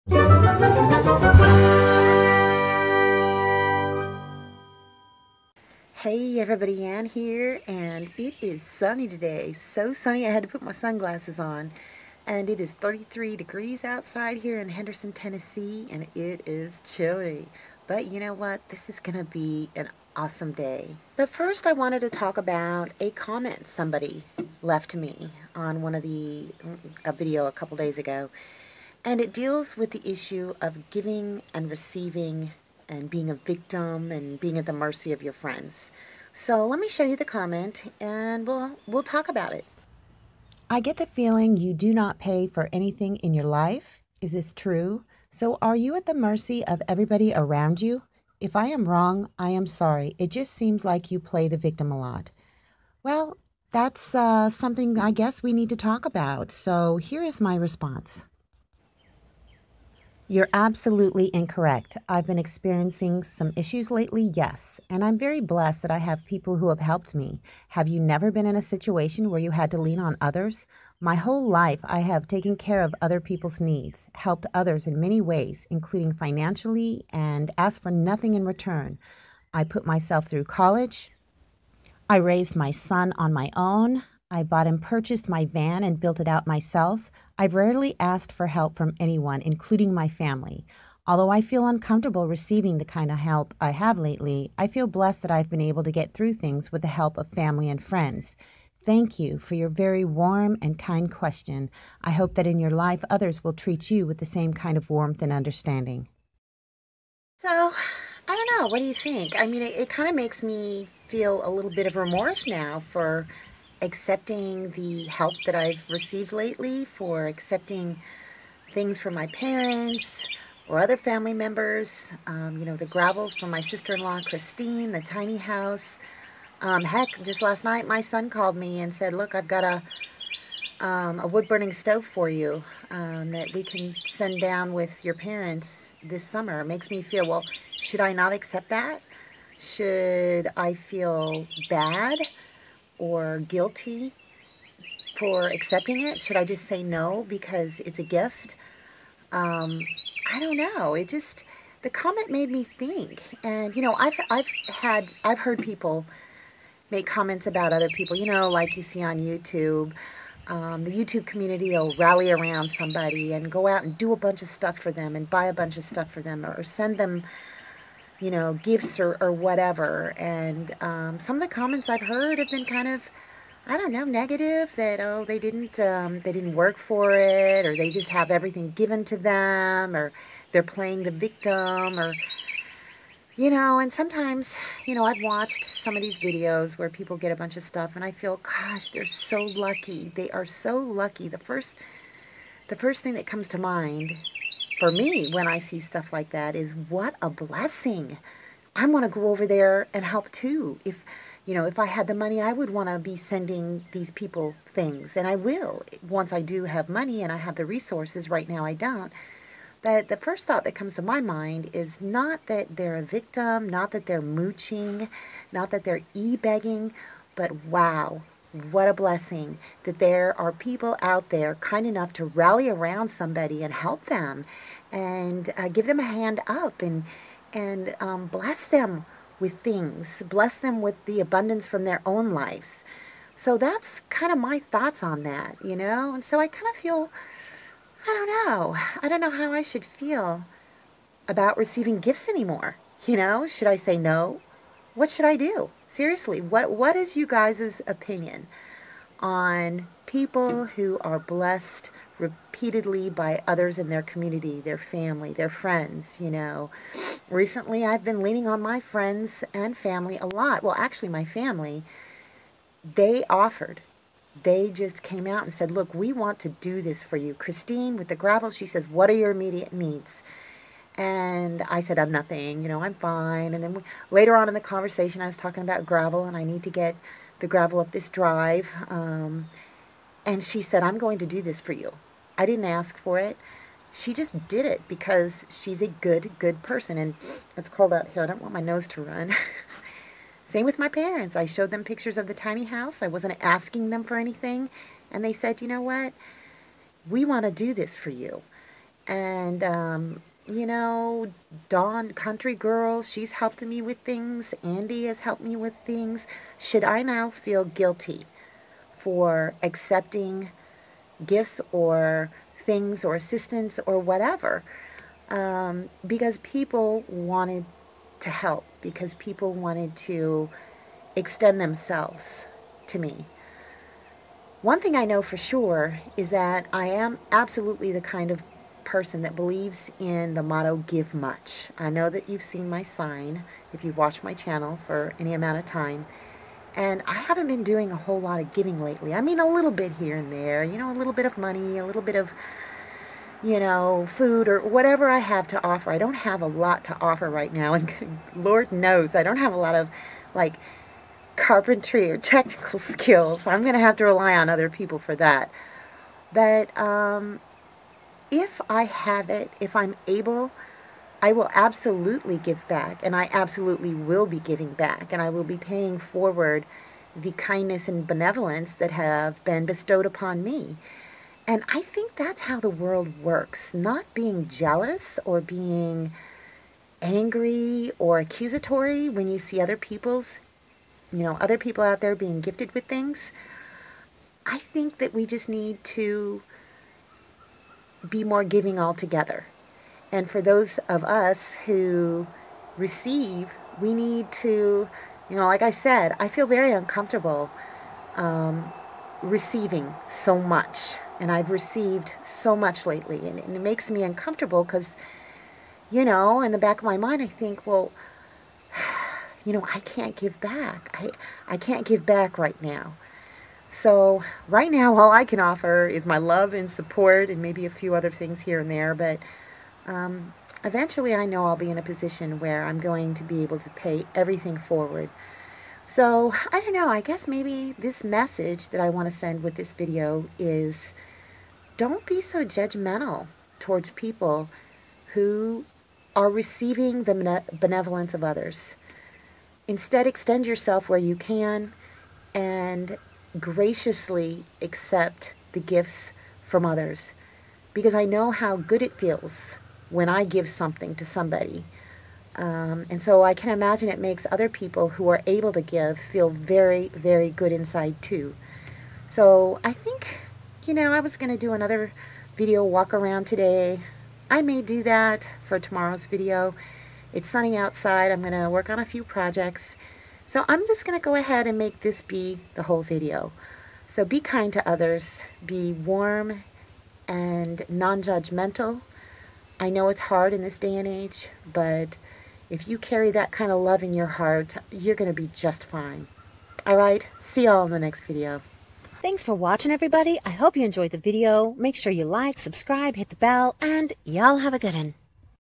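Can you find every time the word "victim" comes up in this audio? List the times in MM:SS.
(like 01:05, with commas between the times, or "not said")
00:33, 00:51, 03:01, 03:33.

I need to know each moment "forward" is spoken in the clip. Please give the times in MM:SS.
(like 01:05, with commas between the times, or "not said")
06:05, 07:04.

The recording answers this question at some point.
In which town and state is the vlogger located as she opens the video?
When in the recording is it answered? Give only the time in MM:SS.
00:14.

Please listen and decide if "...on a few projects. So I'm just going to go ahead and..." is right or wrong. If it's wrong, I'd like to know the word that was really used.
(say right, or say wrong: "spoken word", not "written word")
right.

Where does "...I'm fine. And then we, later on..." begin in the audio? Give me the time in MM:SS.
04:32.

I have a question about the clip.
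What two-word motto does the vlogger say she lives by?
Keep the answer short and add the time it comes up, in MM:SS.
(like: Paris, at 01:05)
give much, at 05:30.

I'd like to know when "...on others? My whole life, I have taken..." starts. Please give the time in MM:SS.
01:09.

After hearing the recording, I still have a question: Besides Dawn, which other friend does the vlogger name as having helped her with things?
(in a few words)
Andy.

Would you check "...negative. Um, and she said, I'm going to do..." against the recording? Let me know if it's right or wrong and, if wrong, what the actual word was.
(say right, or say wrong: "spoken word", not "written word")
wrong: "drive", not "negative".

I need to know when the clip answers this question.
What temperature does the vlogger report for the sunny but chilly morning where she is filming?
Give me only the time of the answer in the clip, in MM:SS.
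00:12.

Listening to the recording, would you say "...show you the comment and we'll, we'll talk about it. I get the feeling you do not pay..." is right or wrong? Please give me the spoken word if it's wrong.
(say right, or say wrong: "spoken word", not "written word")
right.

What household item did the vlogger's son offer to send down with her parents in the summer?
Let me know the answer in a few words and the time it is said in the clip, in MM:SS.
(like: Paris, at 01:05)
wood-burning stove, at 02:11.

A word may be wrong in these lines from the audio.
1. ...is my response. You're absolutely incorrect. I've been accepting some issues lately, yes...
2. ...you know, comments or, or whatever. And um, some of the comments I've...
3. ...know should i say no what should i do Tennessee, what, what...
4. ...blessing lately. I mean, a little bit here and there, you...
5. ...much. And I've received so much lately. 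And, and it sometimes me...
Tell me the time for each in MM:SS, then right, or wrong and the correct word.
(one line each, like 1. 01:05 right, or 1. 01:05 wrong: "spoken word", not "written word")
1. 00:57 wrong: "experiencing", not "accepting"
2. 02:48 wrong: "gifts", not "comments"
3. 04:03 wrong: "Seriously", not "Tennessee"
4. 05:38 wrong: "giving", not "blessing"
5. 06:40 wrong: "makes", not "sometimes".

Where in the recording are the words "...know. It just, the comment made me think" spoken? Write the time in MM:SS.
02:30.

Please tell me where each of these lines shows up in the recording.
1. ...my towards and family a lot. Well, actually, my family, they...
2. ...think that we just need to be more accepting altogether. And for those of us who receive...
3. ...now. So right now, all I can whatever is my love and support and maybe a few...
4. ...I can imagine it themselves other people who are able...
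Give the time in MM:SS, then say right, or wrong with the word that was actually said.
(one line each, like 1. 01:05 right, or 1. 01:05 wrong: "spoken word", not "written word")
1. 04:18 wrong: "friends", not "towards"
2. 06:24 wrong: "giving", not "accepting"
3. 06:52 wrong: "offer", not "whatever"
4. 07:33 wrong: "makes", not "themselves".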